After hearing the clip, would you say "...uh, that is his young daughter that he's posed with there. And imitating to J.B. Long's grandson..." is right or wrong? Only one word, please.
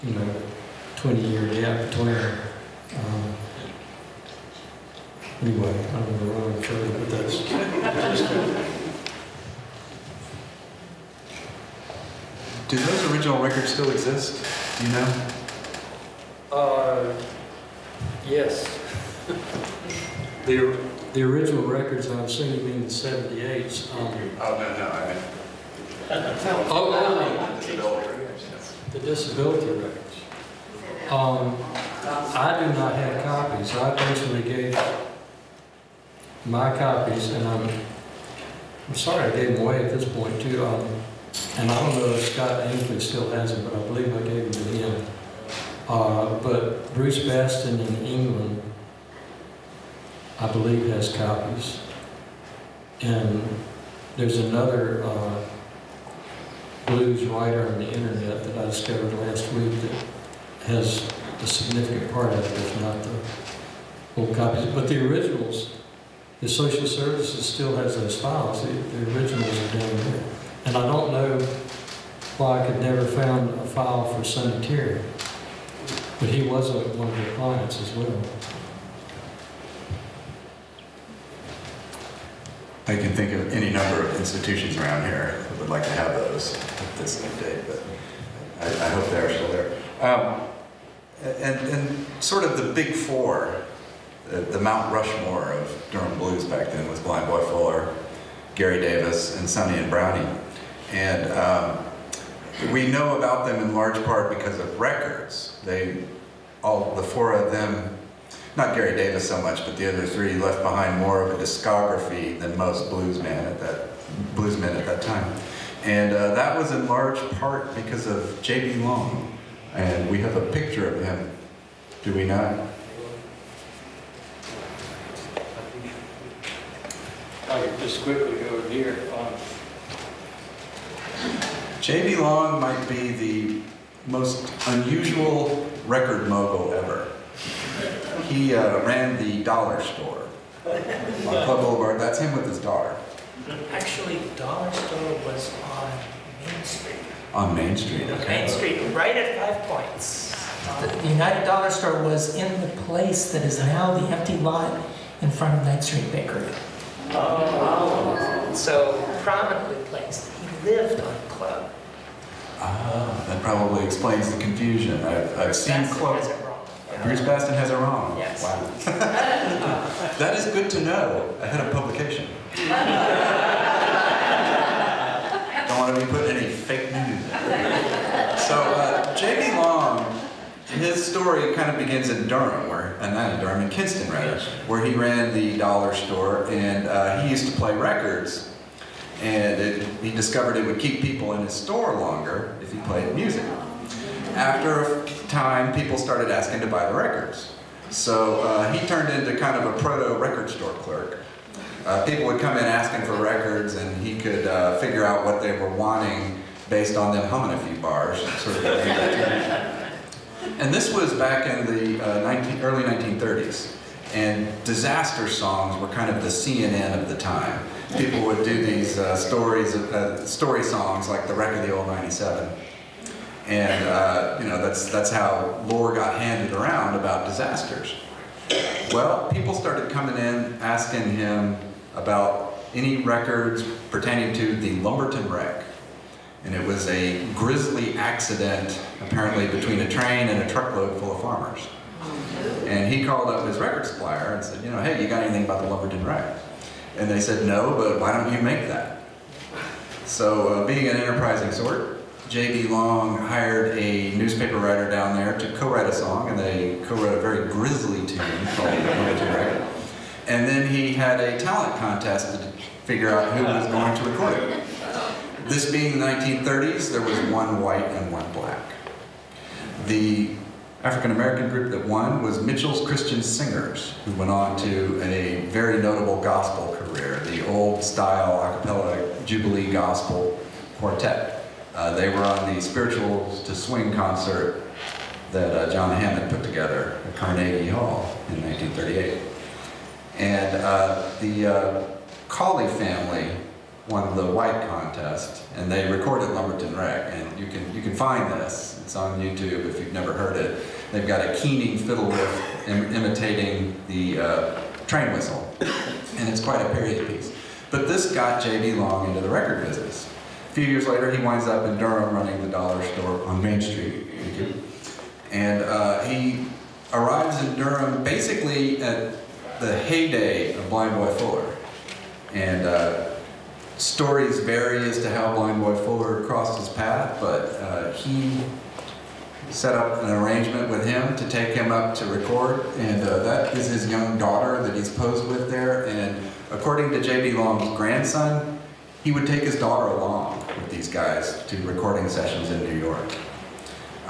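wrong.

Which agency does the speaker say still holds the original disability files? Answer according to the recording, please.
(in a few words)
social services.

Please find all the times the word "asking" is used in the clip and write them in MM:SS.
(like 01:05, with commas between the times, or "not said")
03:16, 03:22, 03:50.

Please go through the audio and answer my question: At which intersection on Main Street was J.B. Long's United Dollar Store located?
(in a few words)
Five Points.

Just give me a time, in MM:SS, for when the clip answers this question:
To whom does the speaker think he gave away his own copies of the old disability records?
00:42.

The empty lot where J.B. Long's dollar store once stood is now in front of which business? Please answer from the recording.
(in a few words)
Ninth Street Bakery.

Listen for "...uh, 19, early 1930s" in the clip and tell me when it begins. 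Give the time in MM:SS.
03:32.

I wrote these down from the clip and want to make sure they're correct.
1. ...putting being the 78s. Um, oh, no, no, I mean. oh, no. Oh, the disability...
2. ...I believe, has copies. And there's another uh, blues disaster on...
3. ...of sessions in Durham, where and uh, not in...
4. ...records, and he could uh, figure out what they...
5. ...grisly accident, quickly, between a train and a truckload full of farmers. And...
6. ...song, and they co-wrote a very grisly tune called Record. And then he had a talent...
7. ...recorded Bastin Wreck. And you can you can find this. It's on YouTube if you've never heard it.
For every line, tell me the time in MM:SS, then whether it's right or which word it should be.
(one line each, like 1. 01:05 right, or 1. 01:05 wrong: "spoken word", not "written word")
1. 00:22 wrong: "assuming", not "putting"
2. 00:50 wrong: "writer", not "disaster"
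3. 03:01 wrong: "begins", not "sessions"
4. 03:23 right
5. 03:57 wrong: "apparently", not "quickly"
6. 04:15 right
7. 04:55 wrong: "Lumberton", not "Bastin".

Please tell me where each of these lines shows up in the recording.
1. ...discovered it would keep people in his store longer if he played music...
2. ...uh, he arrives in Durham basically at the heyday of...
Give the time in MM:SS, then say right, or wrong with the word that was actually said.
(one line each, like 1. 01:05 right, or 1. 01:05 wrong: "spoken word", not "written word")
1. 03:10 right
2. 05:15 right.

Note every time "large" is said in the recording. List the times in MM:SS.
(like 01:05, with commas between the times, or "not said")
01:43, 01:56.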